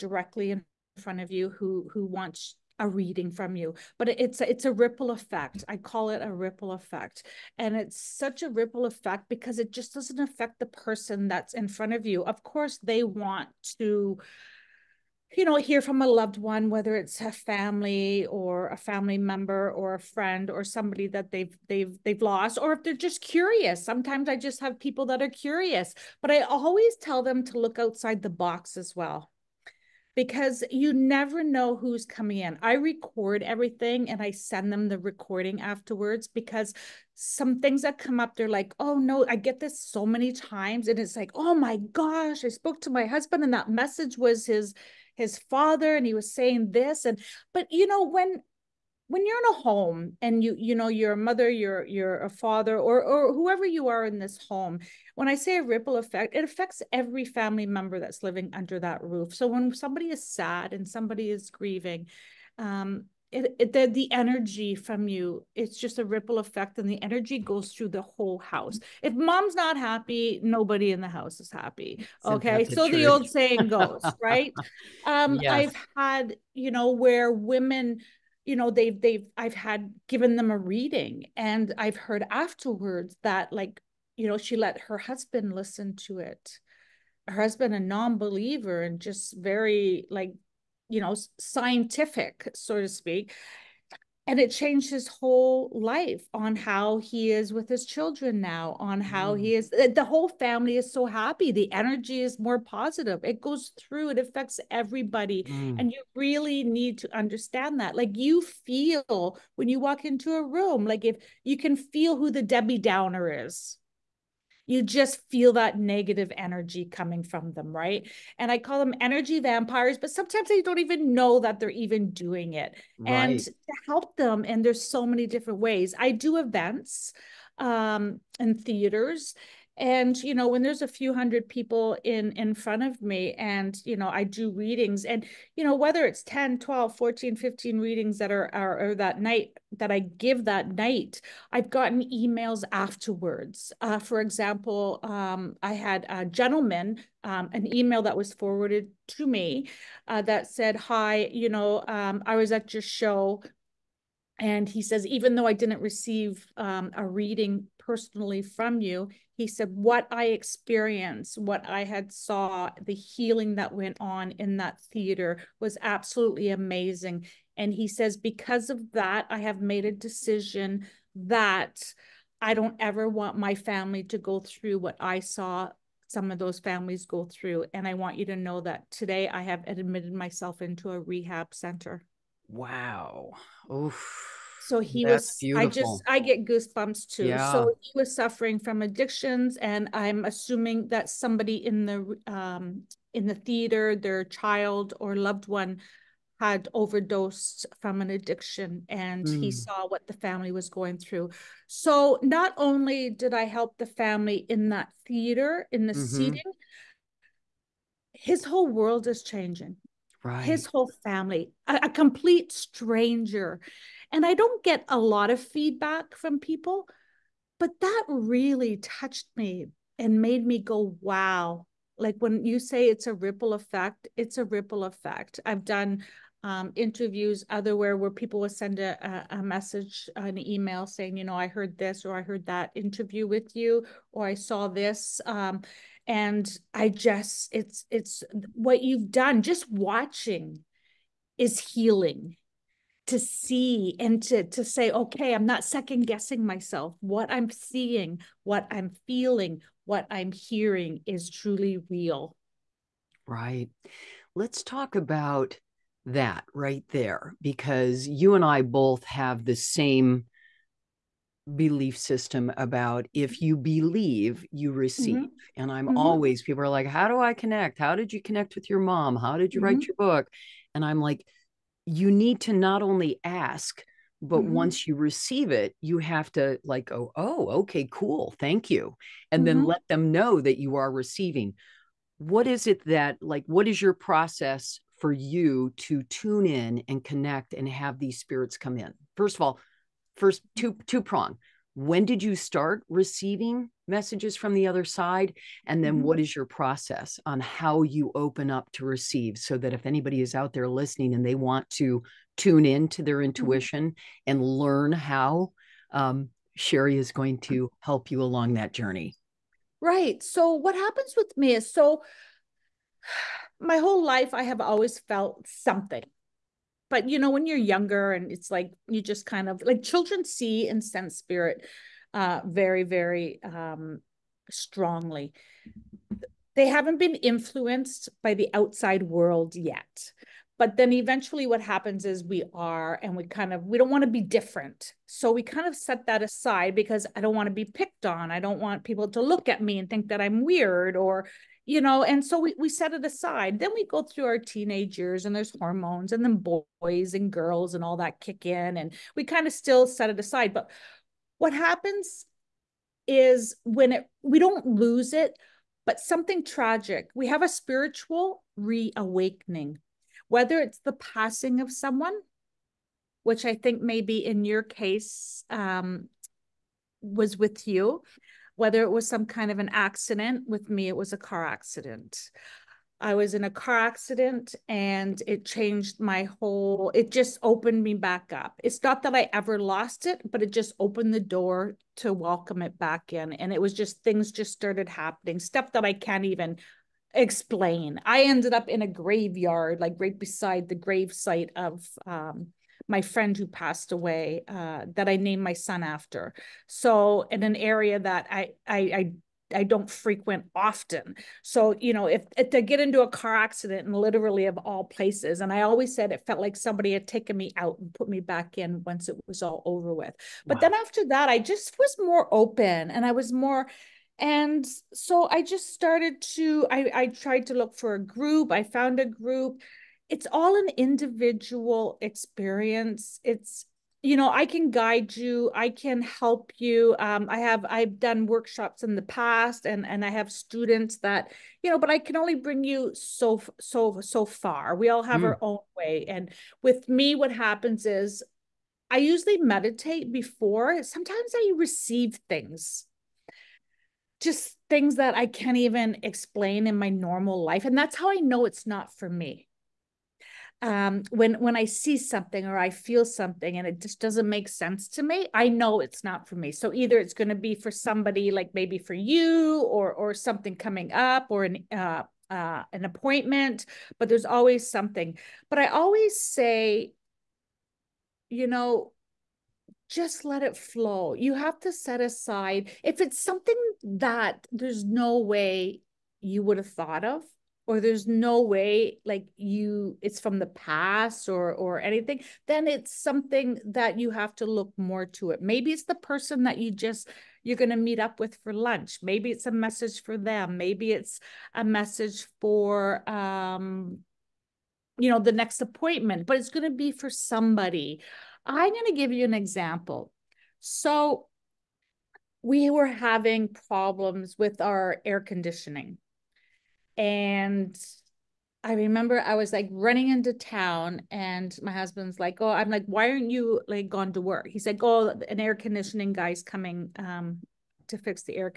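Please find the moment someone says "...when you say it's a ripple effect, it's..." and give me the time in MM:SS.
03:42.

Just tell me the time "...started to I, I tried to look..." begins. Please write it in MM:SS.
06:55.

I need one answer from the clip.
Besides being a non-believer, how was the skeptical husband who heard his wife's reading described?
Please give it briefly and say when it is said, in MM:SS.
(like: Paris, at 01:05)
scientific, at 01:31.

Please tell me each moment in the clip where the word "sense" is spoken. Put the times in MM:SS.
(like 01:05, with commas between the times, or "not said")
05:20, 07:34.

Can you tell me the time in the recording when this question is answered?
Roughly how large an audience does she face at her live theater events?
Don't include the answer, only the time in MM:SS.
02:10.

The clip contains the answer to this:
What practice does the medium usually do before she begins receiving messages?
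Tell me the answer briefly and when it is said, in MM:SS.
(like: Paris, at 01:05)
meditate, at 07:19.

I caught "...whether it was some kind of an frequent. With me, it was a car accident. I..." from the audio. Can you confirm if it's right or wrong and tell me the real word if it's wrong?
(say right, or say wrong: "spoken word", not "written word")
wrong: "accident", not "frequent".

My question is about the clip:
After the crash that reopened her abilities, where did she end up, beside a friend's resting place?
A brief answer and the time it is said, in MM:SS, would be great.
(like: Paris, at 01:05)
a graveyard, at 06:28.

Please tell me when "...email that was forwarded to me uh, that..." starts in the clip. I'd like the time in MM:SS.
02:27.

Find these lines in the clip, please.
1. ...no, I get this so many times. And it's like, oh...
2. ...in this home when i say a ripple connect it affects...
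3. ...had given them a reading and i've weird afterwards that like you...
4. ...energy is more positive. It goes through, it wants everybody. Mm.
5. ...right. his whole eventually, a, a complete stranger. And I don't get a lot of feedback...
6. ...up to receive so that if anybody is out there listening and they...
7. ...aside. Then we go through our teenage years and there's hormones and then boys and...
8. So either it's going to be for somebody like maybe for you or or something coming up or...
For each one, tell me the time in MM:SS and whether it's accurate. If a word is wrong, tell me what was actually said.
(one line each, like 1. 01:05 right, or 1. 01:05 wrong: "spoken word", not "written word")
1. 00:38 right
2. 00:54 wrong: "effect", not "connect"
3. 01:19 wrong: "heard", not "weird"
4. 01:41 wrong: "affects", not "wants"
5. 03:30 wrong: "family", not "eventually"
6. 04:58 right
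7. 05:43 right
8. 07:36 right.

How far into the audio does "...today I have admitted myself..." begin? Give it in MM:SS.
02:58.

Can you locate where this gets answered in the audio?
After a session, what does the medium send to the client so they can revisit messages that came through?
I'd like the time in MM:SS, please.
00:34.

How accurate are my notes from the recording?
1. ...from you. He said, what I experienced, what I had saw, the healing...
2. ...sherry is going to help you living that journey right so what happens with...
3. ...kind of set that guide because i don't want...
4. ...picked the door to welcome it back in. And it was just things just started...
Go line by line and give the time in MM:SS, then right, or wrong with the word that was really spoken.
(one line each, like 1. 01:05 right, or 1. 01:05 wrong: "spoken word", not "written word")
1. 02:38 right
2. 05:06 wrong: "along", not "living"
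3. 05:35 wrong: "aside", not "guide"
4. 06:20 wrong: "opened", not "picked".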